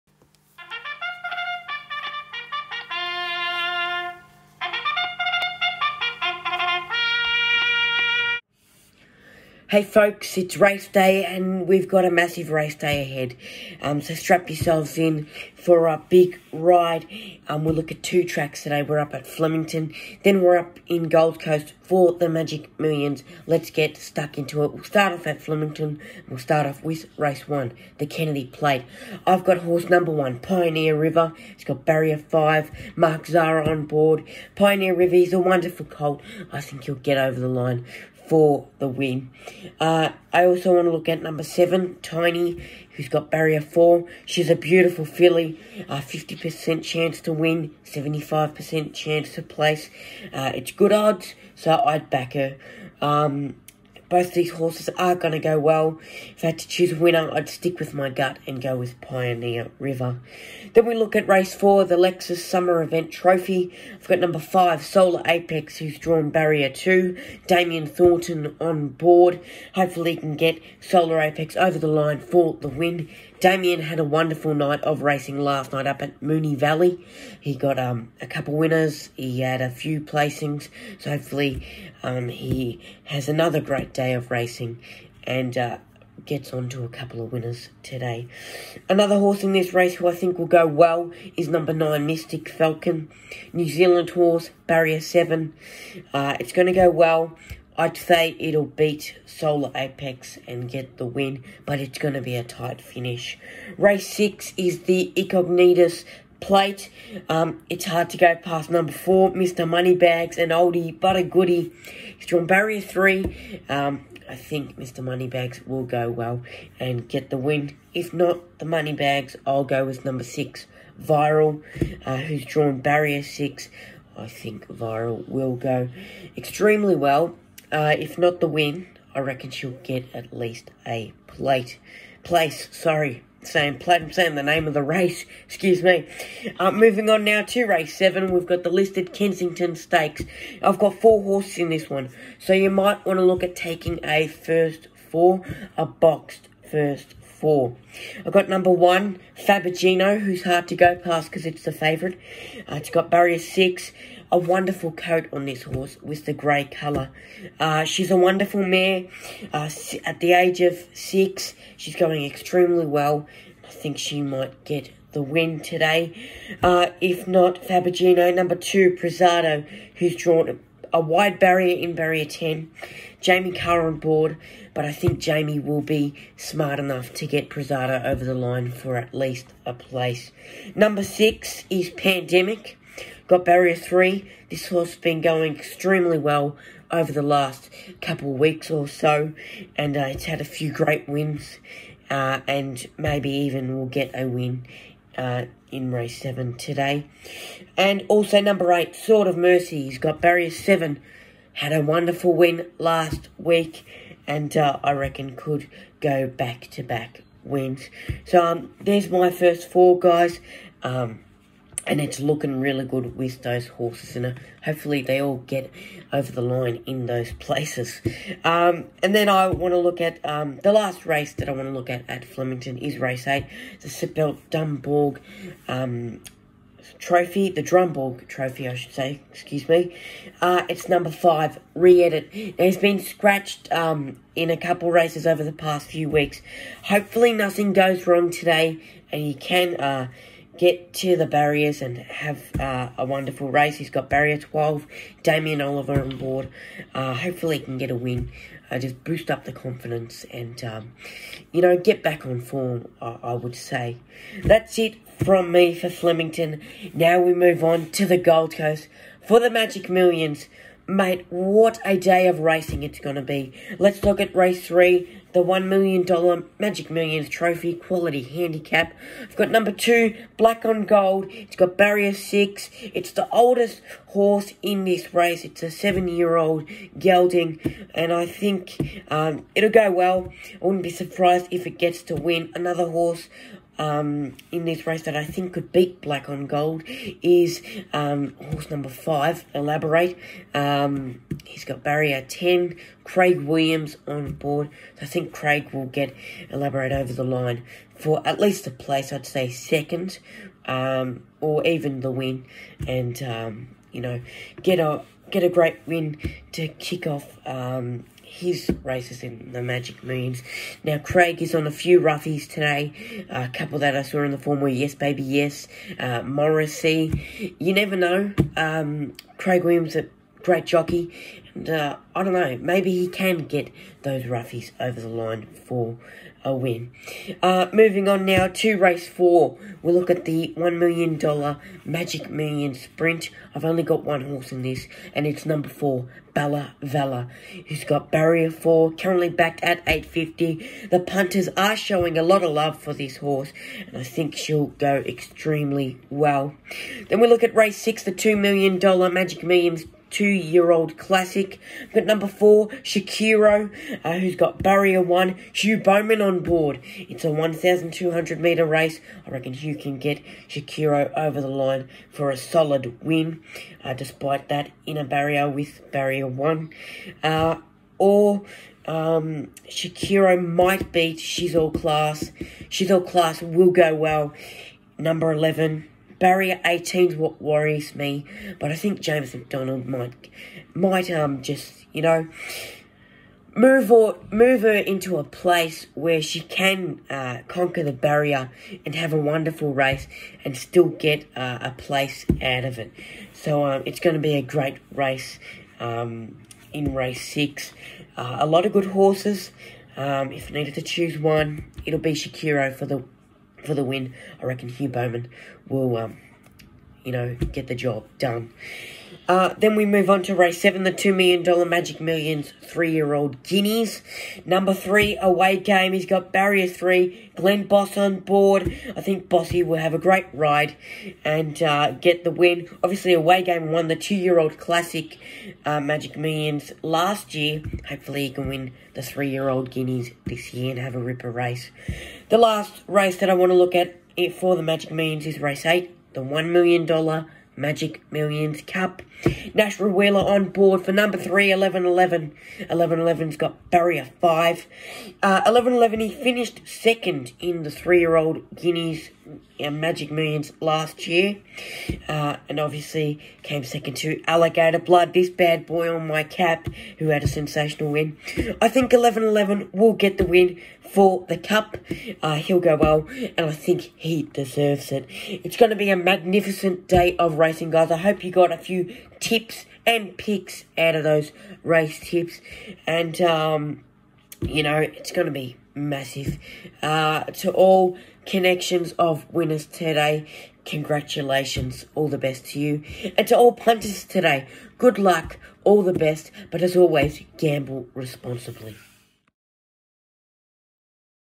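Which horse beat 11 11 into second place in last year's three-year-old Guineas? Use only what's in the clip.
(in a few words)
Alligator Blood.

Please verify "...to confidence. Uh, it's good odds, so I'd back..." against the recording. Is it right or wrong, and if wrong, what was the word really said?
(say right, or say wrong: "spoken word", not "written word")
wrong: "place", not "confidence".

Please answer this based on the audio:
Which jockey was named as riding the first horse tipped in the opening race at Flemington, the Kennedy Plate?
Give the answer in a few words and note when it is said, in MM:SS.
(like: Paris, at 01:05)
Mark Zahra, at 00:32.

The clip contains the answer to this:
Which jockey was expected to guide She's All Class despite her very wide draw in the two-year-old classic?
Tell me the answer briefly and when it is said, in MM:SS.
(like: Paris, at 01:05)
James McDonald, at 06:18.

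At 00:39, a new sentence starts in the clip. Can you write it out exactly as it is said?
Uh, I also want to look at number seven, Tiny, who's got barrier four.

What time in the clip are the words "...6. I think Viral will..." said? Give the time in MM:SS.
02:03.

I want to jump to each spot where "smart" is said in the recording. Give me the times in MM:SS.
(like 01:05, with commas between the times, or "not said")
02:56.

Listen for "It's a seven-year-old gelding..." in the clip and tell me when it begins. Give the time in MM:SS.
04:35.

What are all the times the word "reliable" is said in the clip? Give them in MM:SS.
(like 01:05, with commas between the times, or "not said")
not said.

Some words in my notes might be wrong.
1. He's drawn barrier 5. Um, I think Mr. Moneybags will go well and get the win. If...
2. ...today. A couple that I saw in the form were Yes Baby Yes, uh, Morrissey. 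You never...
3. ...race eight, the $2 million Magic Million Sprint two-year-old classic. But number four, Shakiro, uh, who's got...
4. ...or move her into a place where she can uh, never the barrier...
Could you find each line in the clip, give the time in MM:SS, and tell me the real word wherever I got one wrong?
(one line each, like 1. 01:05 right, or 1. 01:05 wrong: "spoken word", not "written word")
1. 01:52 wrong: "3", not "5"
2. 05:12 right
3. 05:47 wrong: "six", not "eight"
4. 06:23 wrong: "conquer", not "never".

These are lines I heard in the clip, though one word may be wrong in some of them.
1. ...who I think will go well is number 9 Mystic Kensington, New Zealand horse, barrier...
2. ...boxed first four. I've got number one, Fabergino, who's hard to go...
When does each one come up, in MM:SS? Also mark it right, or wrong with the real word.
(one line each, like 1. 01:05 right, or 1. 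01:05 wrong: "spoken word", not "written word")
1. 01:29 wrong: "Falcon", not "Kensington"
2. 02:25 right.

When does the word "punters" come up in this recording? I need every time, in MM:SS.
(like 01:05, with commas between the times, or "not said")
05:41, 08:03.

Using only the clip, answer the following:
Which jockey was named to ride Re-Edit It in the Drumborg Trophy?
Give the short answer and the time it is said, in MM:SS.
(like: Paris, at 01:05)
Damien Oliver, at 04:05.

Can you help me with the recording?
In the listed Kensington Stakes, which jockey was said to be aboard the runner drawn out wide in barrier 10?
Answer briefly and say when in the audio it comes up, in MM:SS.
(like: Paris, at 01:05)
Jamie Kah, at 02:53.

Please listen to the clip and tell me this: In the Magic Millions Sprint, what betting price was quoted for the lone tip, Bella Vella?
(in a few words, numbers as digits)
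8.50.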